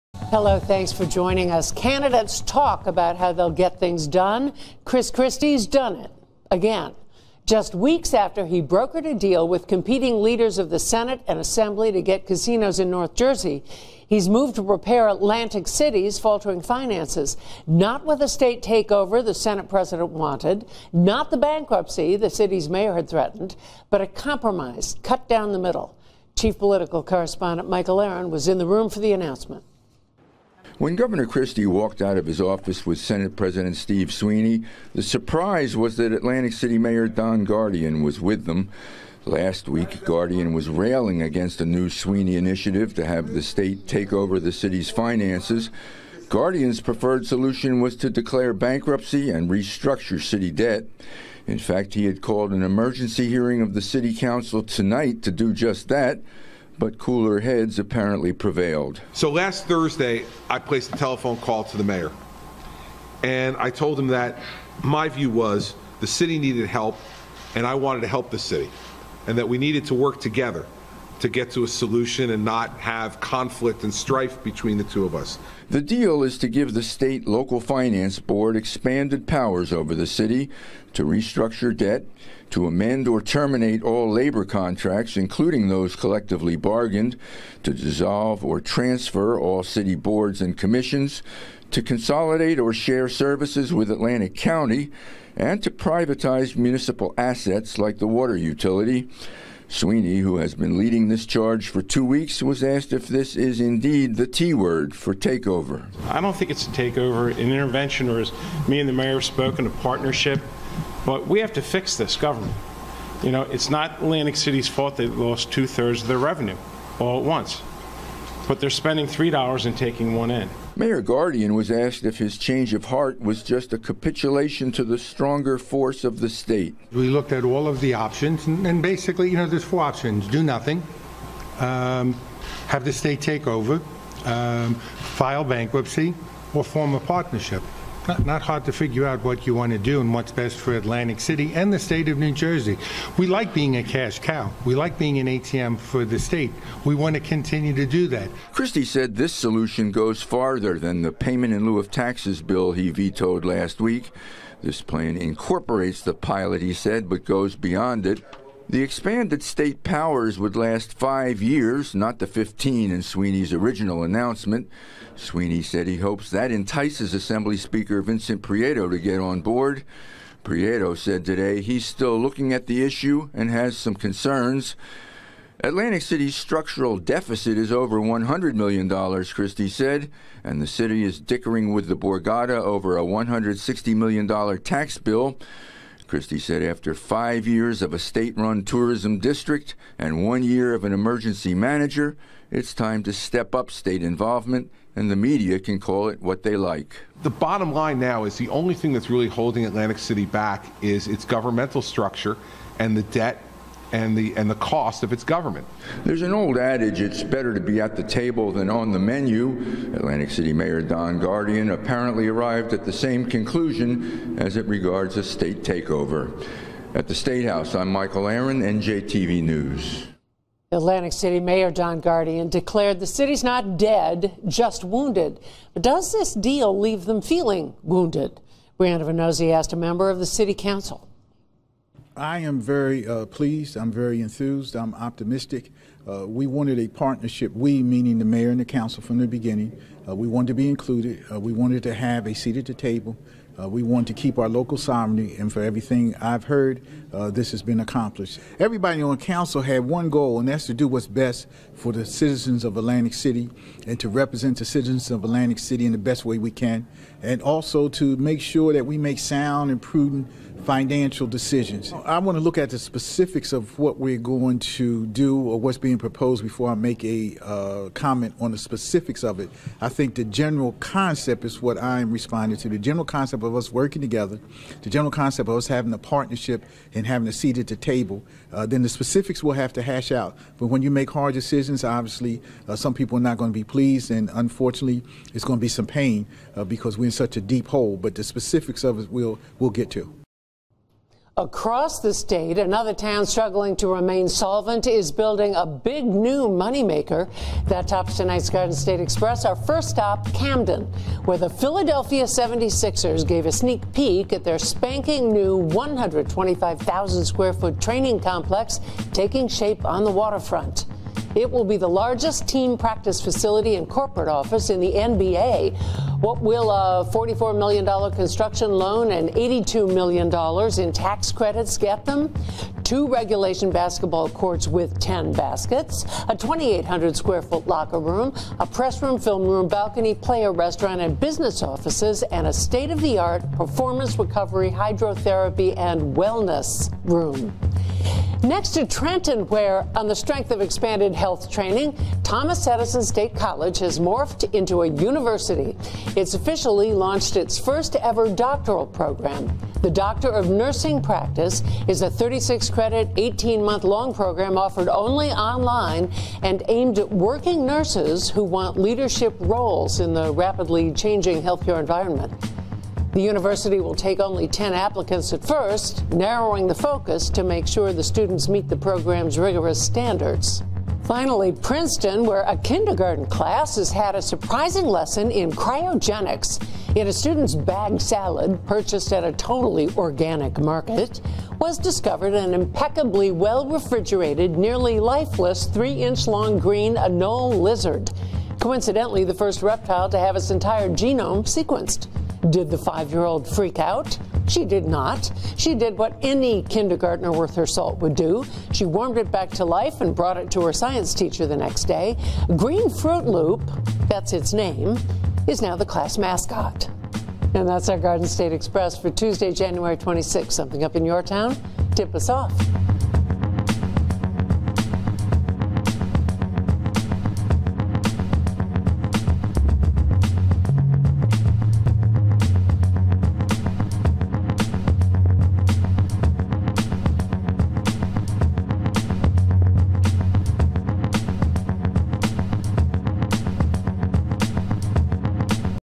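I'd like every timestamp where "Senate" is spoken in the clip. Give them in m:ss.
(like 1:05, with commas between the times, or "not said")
0:10, 0:19, 0:32.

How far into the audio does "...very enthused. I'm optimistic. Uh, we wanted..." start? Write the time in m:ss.
3:53.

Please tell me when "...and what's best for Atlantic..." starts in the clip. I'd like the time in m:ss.
2:20.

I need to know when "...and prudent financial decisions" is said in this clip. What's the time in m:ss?
4:19.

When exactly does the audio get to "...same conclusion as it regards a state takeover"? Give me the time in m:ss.
3:32.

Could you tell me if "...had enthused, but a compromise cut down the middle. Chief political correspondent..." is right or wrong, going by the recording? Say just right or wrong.
wrong.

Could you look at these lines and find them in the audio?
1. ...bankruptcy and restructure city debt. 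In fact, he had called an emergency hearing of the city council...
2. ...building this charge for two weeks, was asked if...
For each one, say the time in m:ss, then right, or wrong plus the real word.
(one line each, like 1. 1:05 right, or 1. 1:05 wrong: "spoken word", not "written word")
1. 0:48 right
2. 1:40 wrong: "leading", not "building".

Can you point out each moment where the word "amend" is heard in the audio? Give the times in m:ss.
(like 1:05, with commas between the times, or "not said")
1:22.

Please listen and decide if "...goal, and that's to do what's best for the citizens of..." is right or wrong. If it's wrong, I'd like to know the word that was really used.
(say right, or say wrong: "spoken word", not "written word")
right.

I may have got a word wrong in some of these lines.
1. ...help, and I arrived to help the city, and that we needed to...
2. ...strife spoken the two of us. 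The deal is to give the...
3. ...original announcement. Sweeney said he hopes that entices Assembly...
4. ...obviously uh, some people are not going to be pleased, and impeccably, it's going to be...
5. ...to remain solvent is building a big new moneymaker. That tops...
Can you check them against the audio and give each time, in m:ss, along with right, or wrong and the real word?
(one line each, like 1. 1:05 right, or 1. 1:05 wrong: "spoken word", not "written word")
1. 1:06 wrong: "wanted", not "arrived"
2. 1:13 wrong: "between", not "spoken"
3. 2:43 right
4. 4:41 wrong: "unfortunately", not "impeccably"
5. 4:53 right.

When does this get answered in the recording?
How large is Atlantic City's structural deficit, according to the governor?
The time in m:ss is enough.
2:57.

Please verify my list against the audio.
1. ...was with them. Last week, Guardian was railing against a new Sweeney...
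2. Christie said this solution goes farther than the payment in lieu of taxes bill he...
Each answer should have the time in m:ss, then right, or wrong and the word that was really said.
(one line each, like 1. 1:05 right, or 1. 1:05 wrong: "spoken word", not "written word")
1. 0:38 right
2. 2:28 right.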